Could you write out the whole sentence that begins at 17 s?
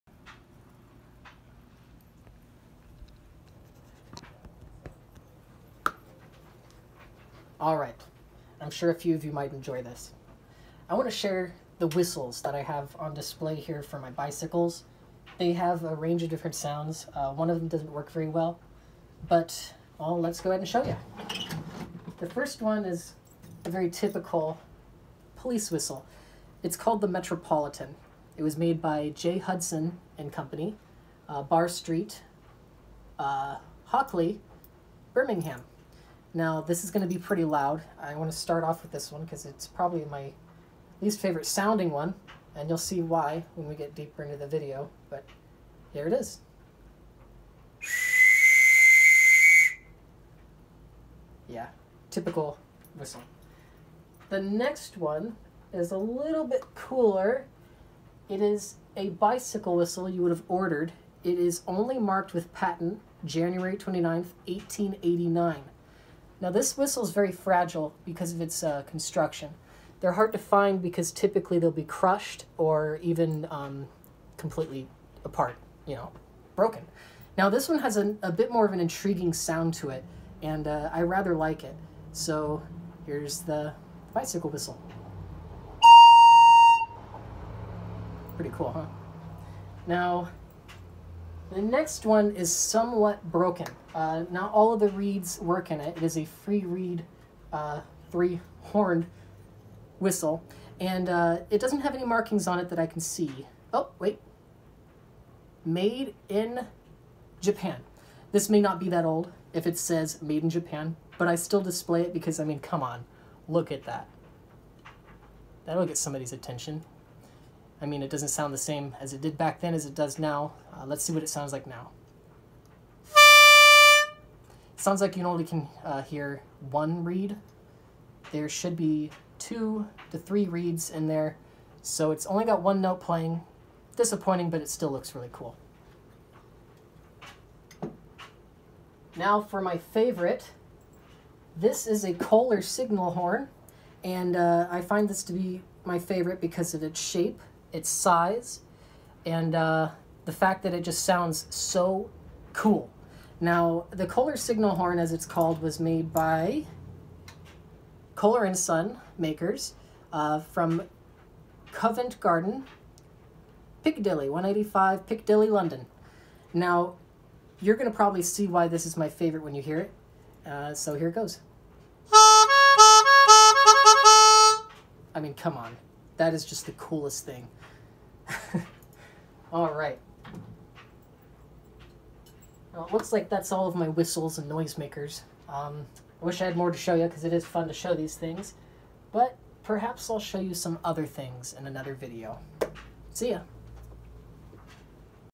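Uh, one of them doesn't work very well, but well, let's go ahead and show you.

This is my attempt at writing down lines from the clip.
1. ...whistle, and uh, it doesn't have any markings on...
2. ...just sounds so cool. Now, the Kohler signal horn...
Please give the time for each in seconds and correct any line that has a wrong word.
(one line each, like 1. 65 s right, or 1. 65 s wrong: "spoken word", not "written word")
1. 99 s right
2. 150 s right.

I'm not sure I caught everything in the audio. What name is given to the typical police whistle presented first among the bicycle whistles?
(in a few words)
Metropolitan.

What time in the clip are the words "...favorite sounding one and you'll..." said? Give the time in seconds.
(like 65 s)
41 s.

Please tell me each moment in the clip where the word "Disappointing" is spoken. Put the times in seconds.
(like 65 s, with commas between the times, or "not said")
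133 s.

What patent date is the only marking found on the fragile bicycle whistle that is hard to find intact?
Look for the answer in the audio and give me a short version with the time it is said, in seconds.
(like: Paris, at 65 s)
January 29th, 1889, at 63 s.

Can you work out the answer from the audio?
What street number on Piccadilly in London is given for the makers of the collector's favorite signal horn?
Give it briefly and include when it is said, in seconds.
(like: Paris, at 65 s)
185, at 164 s.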